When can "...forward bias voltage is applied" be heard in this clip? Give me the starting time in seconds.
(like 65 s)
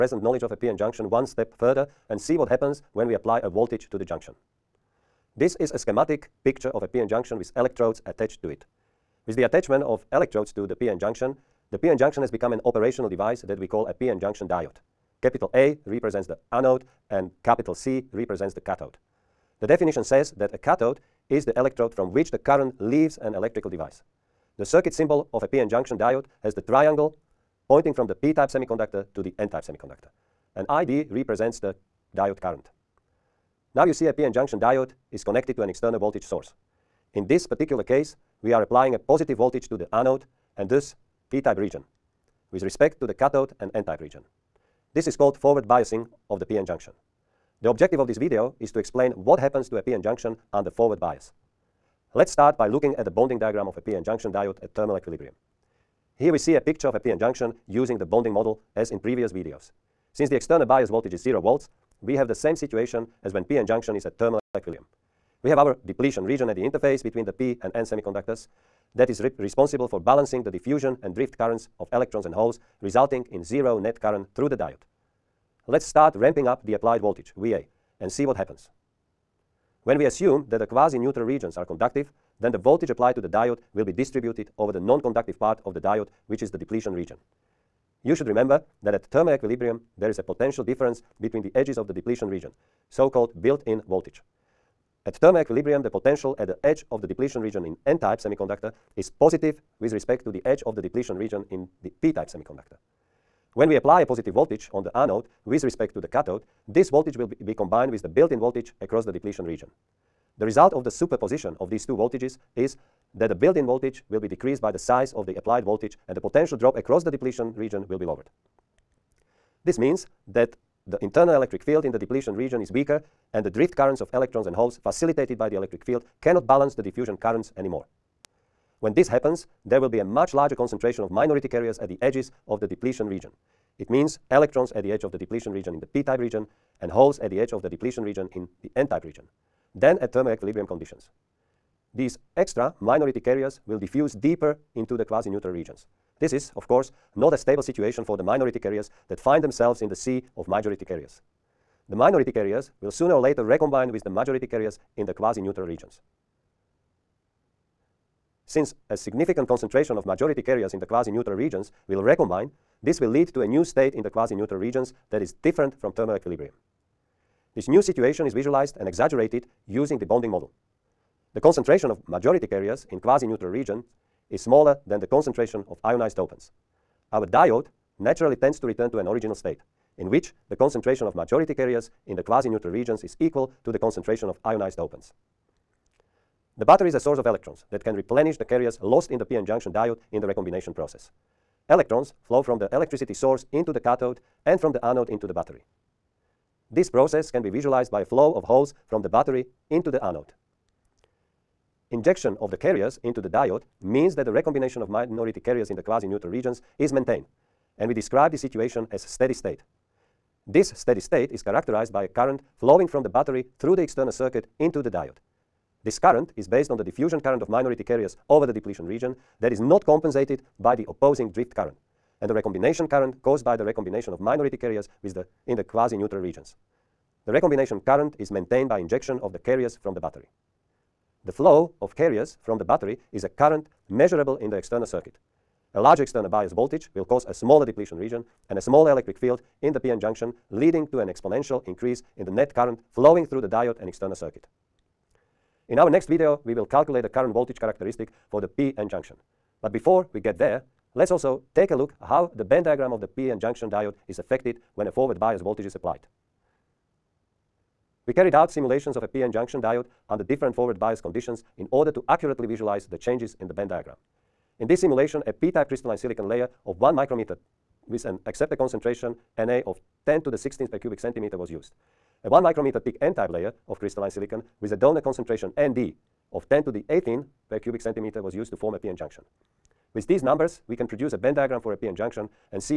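254 s.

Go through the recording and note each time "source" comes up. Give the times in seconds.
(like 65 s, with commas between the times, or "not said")
36 s, 186 s, 193 s.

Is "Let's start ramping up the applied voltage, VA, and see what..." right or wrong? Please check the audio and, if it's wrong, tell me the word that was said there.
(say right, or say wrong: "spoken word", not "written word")
right.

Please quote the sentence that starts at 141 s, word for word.
These extra minority carriers will diffuse deeper into the quasi-neutral regions.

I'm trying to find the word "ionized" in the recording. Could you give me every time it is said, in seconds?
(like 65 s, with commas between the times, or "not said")
175 s, 184 s.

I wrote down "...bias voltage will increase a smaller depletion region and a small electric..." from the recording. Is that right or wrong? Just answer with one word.
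wrong.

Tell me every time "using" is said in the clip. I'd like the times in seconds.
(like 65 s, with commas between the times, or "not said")
57 s, 169 s.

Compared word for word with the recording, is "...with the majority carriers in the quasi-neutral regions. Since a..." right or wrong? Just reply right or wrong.
right.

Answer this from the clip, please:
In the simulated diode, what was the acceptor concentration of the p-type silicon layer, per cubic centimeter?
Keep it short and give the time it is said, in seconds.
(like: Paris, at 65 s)
10^16, at 270 s.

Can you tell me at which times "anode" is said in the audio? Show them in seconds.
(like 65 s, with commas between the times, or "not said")
16 s, 39 s, 104 s, 194 s, 200 s.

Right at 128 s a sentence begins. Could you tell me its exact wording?
When this happens, there will be a much larger concentration of minority carriers at the edges of the depletion region.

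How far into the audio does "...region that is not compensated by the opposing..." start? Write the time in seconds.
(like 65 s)
218 s.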